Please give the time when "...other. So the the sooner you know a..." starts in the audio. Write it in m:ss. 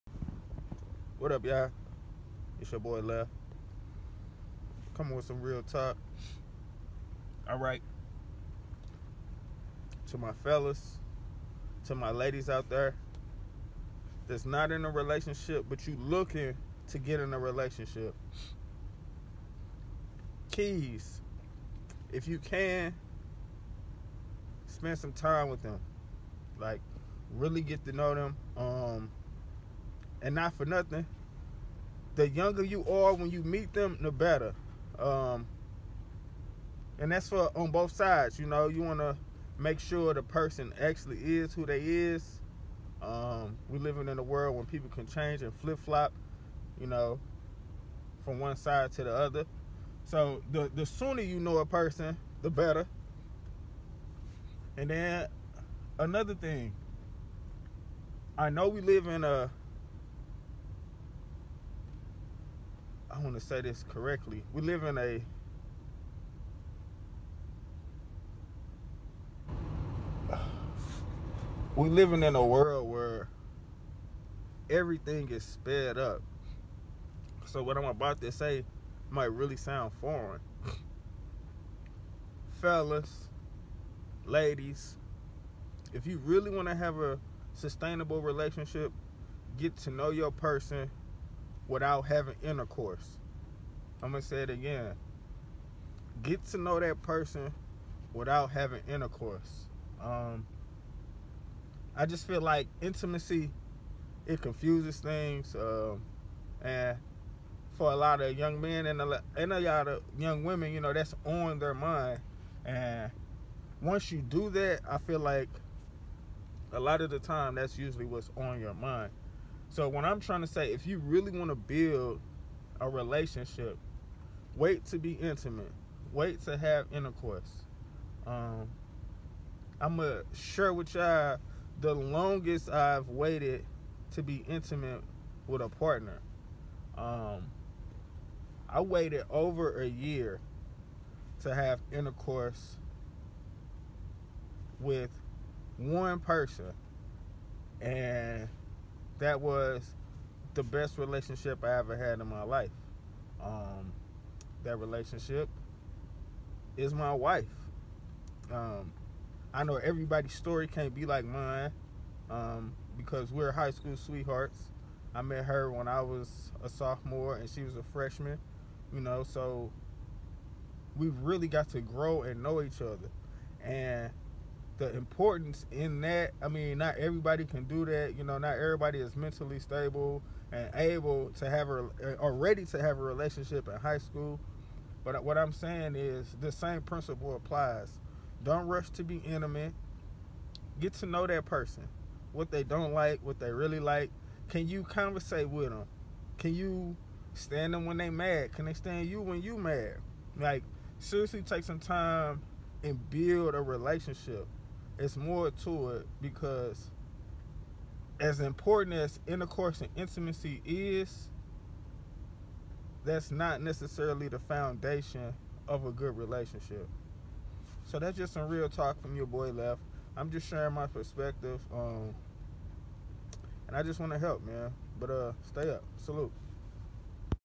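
0:49.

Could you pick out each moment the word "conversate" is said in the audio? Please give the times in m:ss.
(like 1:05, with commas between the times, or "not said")
3:14.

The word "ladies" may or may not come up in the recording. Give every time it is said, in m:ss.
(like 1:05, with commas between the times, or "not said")
0:12, 1:24.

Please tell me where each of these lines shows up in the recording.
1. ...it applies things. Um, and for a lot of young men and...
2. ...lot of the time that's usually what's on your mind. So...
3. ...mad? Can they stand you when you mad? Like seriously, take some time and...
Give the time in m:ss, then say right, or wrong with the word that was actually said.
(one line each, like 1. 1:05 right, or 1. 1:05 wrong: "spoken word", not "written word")
1. 1:44 wrong: "confuses", not "applies"
2. 1:56 right
3. 3:18 right.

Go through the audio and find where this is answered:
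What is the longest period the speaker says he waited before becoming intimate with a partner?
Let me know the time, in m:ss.
2:19.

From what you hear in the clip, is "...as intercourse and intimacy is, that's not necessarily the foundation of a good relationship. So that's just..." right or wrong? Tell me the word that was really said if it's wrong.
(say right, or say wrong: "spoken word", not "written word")
right.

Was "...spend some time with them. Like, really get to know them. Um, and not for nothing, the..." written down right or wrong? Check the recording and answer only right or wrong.
right.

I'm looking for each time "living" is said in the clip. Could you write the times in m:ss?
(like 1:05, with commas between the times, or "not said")
0:43, 1:11.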